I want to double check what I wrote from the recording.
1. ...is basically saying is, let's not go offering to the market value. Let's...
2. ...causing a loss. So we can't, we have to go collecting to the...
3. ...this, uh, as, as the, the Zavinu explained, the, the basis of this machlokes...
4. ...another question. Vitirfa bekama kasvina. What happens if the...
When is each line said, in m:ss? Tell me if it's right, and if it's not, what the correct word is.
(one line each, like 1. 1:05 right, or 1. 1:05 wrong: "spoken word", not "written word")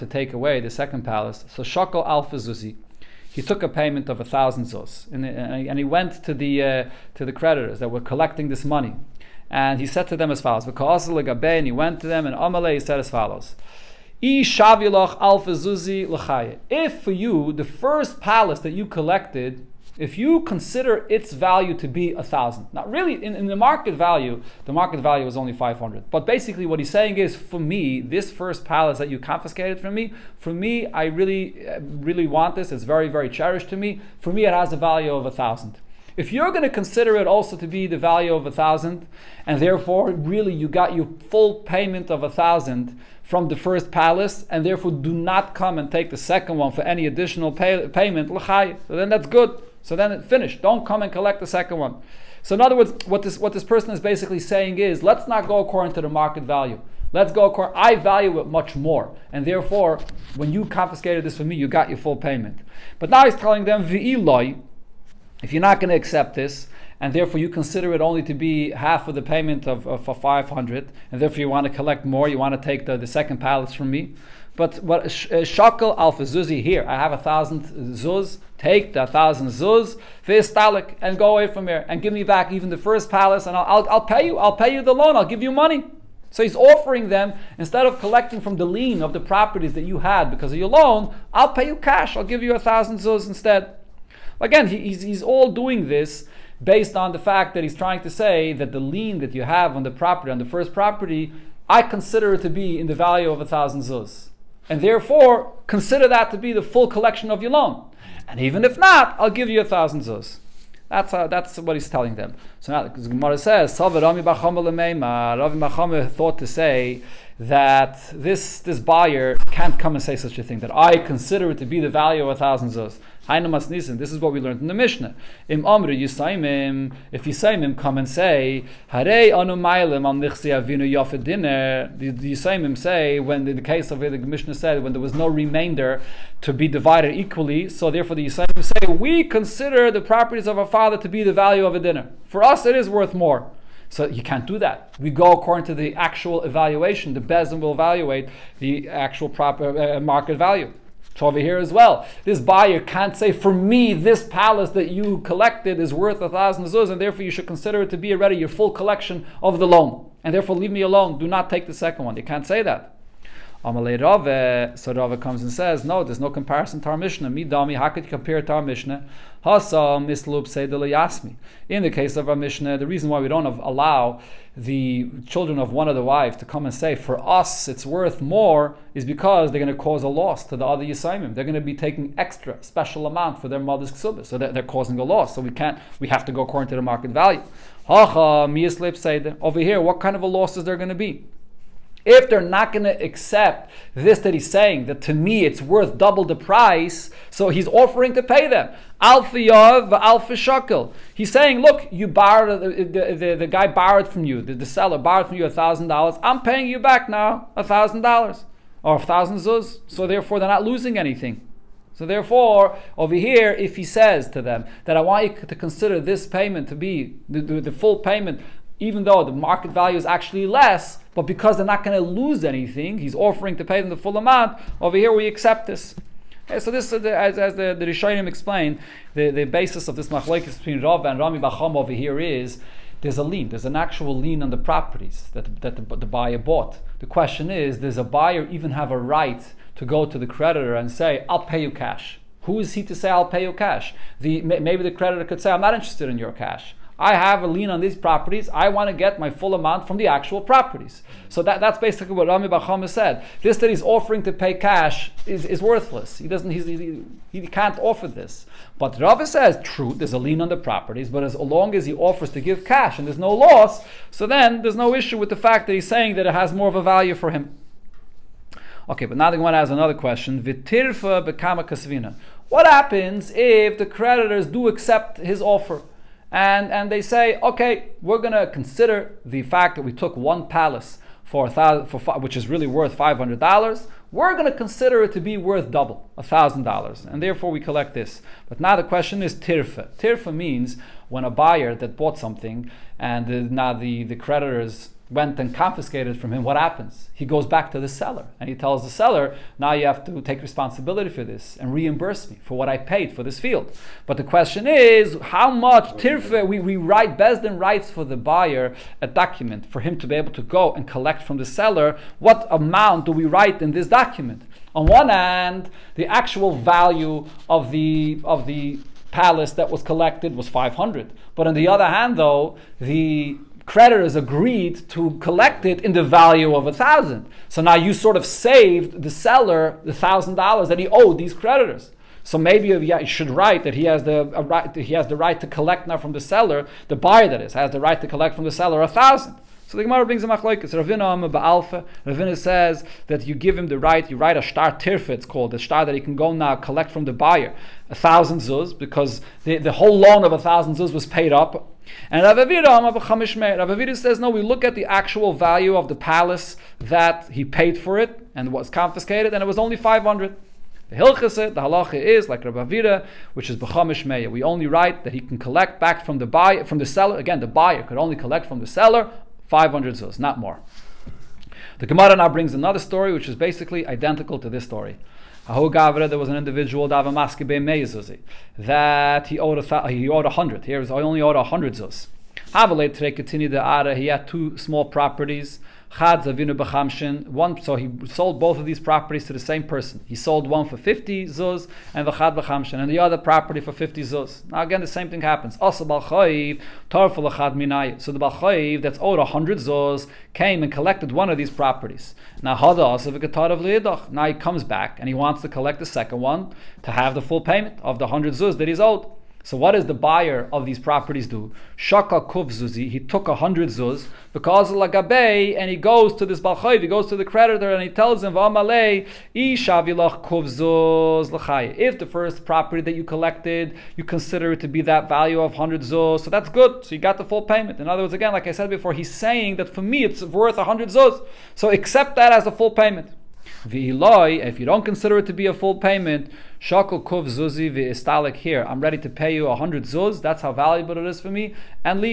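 1. 0:53 wrong: "according", not "offering"
2. 3:04 wrong: "according", not "collecting"
3. 3:46 wrong: "Rishonim", not "Zavinu"
4. 4:29 right.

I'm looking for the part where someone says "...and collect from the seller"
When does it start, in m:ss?
5:10.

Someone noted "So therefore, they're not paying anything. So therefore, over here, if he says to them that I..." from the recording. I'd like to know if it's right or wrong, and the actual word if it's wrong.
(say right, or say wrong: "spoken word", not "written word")
wrong: "losing", not "paying".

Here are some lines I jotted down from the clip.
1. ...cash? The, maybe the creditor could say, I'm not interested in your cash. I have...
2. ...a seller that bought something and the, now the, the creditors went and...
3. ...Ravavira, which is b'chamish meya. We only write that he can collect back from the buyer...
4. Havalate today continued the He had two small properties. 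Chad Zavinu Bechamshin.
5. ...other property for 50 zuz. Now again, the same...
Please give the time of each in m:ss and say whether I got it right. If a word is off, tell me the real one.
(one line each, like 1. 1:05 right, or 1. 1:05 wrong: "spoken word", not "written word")
1. 4:03 right
2. 4:51 wrong: "buyer", not "seller"
3. 6:02 right
4. 6:22 right
5. 6:32 right.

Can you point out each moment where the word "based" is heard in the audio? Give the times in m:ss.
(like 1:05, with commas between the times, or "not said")
1:36.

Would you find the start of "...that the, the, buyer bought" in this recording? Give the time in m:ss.
3:55.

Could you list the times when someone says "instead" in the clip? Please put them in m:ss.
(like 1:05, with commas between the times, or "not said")
1:27, 1:33.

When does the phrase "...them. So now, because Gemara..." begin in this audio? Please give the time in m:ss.
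1:52.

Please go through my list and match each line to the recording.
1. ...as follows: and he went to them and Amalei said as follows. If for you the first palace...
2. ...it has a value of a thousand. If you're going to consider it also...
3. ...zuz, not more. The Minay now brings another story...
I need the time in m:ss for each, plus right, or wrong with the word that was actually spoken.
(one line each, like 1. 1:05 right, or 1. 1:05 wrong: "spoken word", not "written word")
1. 0:10 right
2. 0:34 right
3. 6:09 wrong: "Gemara", not "Minay".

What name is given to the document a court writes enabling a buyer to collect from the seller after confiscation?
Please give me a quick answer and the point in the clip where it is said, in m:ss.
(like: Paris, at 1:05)
shtar tirfa, at 5:44.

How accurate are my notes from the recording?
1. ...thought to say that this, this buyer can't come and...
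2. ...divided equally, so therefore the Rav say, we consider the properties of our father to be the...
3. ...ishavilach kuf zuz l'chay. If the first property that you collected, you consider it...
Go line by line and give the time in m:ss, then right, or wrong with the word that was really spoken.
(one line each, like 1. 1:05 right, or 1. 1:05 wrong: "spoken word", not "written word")
1. 1:56 right
2. 2:16 wrong: "Yisaimim", not "Rav"
3. 6:59 right.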